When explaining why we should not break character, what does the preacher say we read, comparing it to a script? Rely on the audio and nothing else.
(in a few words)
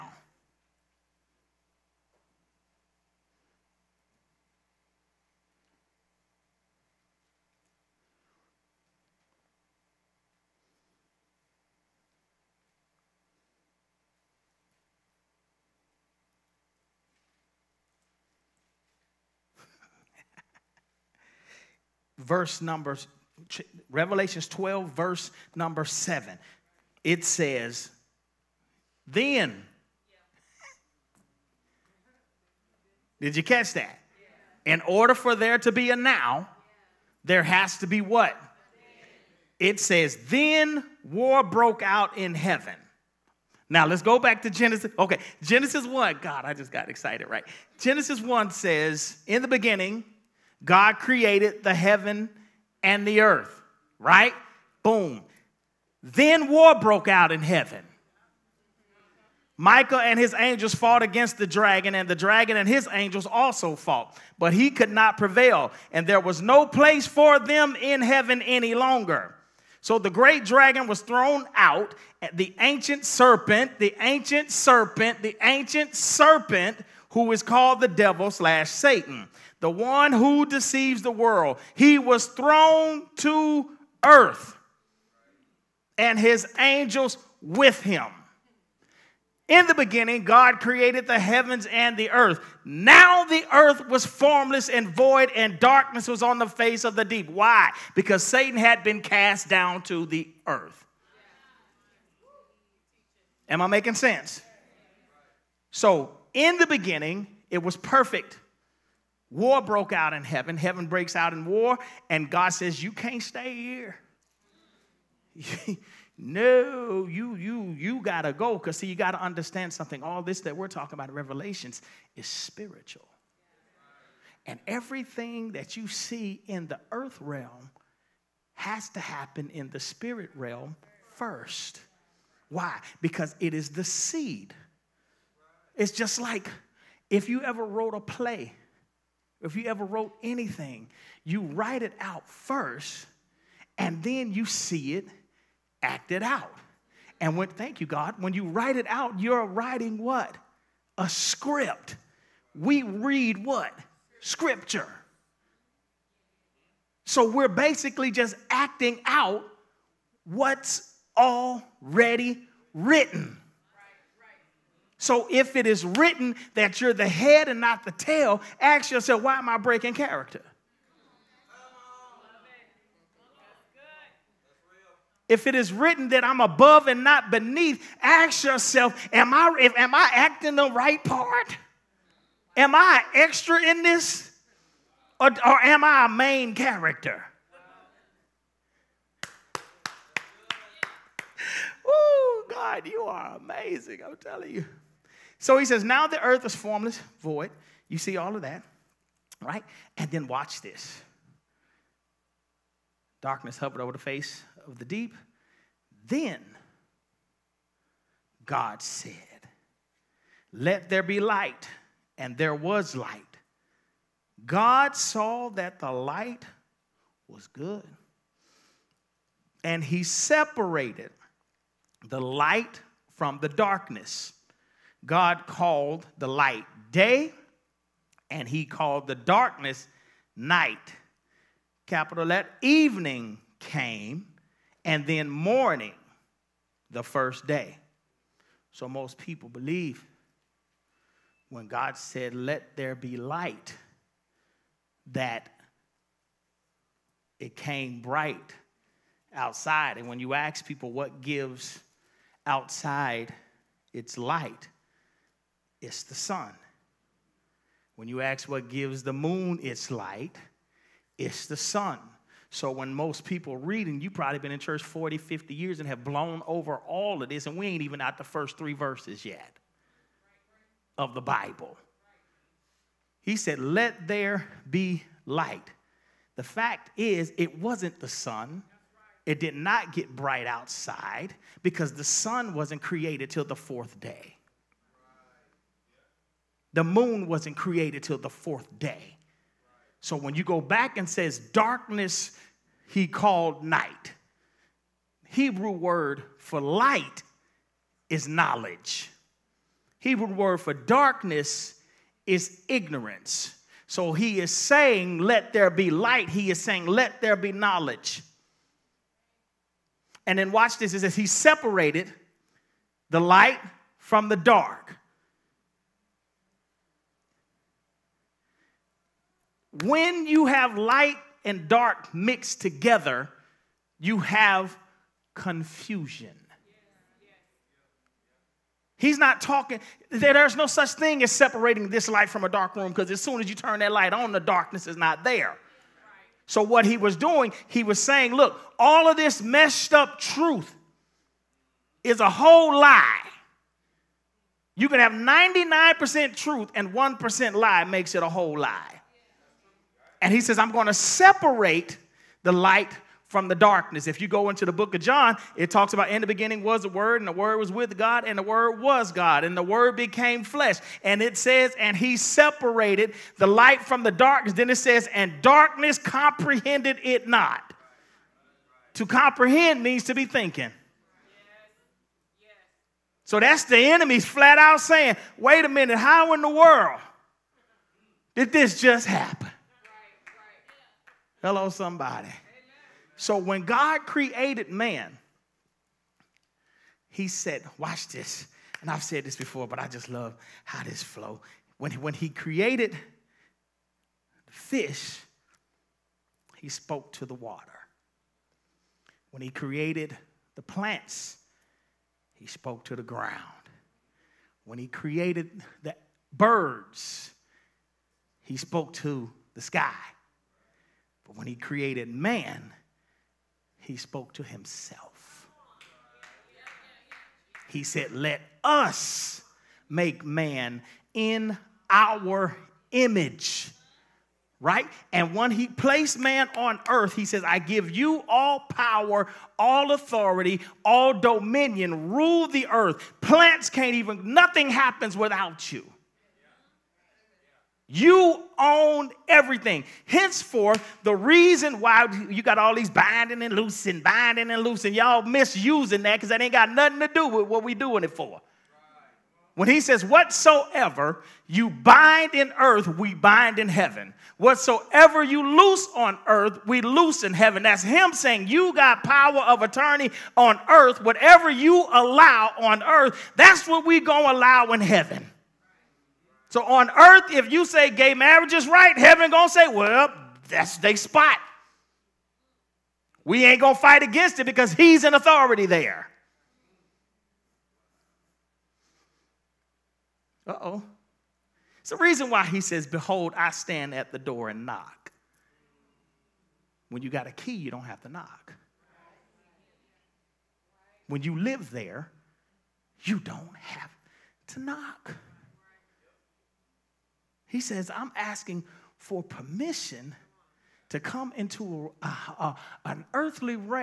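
Scripture.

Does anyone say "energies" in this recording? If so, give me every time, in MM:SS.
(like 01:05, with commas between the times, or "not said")
not said.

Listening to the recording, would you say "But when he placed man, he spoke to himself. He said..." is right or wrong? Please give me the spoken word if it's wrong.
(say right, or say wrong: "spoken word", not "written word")
wrong: "created", not "placed".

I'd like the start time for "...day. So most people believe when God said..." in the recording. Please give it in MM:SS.
03:57.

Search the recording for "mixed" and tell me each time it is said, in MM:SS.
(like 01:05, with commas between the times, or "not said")
05:22.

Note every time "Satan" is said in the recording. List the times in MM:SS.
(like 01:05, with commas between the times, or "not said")
01:18, 01:38.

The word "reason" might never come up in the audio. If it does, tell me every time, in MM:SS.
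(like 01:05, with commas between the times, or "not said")
07:21, 08:01.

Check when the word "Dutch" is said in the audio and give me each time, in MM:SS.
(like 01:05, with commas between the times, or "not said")
not said.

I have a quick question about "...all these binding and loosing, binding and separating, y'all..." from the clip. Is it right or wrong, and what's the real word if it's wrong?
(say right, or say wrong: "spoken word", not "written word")
wrong: "loosing", not "separating".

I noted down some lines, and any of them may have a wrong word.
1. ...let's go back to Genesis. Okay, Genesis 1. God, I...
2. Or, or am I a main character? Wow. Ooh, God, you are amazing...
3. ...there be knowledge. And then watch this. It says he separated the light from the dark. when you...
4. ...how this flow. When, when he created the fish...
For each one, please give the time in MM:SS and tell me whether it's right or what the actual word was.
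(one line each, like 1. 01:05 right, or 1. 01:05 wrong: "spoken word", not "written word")
1. 00:43 right
2. 03:05 right
3. 05:07 right
4. 06:30 right.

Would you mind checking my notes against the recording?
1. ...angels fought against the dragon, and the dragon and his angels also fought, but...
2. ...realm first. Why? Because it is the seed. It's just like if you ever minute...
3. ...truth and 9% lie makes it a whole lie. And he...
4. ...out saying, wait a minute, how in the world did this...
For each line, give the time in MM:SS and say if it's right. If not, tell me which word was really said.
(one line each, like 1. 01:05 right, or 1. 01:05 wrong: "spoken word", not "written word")
1. 01:00 right
2. 02:10 wrong: "wrote", not "minute"
3. 05:46 wrong: "1", not "9"
4. 06:14 right.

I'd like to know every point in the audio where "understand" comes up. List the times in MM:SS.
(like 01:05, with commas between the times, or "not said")
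01:59.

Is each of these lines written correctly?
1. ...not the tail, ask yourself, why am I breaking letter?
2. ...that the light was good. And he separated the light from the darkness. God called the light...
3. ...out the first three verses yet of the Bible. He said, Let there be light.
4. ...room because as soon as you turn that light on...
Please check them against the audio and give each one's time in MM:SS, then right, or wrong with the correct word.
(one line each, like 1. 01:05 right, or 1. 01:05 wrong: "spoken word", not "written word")
1. 02:47 wrong: "character", not "letter"
2. 03:35 right
3. 04:28 right
4. 05:32 right.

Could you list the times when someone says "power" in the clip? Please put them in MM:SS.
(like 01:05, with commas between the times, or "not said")
07:08, 07:39.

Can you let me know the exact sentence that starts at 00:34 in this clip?
In order for there to be a now, there has to be what?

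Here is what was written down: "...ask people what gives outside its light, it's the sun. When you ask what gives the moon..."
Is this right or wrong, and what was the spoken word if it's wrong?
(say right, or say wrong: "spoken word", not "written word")
right.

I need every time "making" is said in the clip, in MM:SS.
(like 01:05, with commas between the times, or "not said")
01:43.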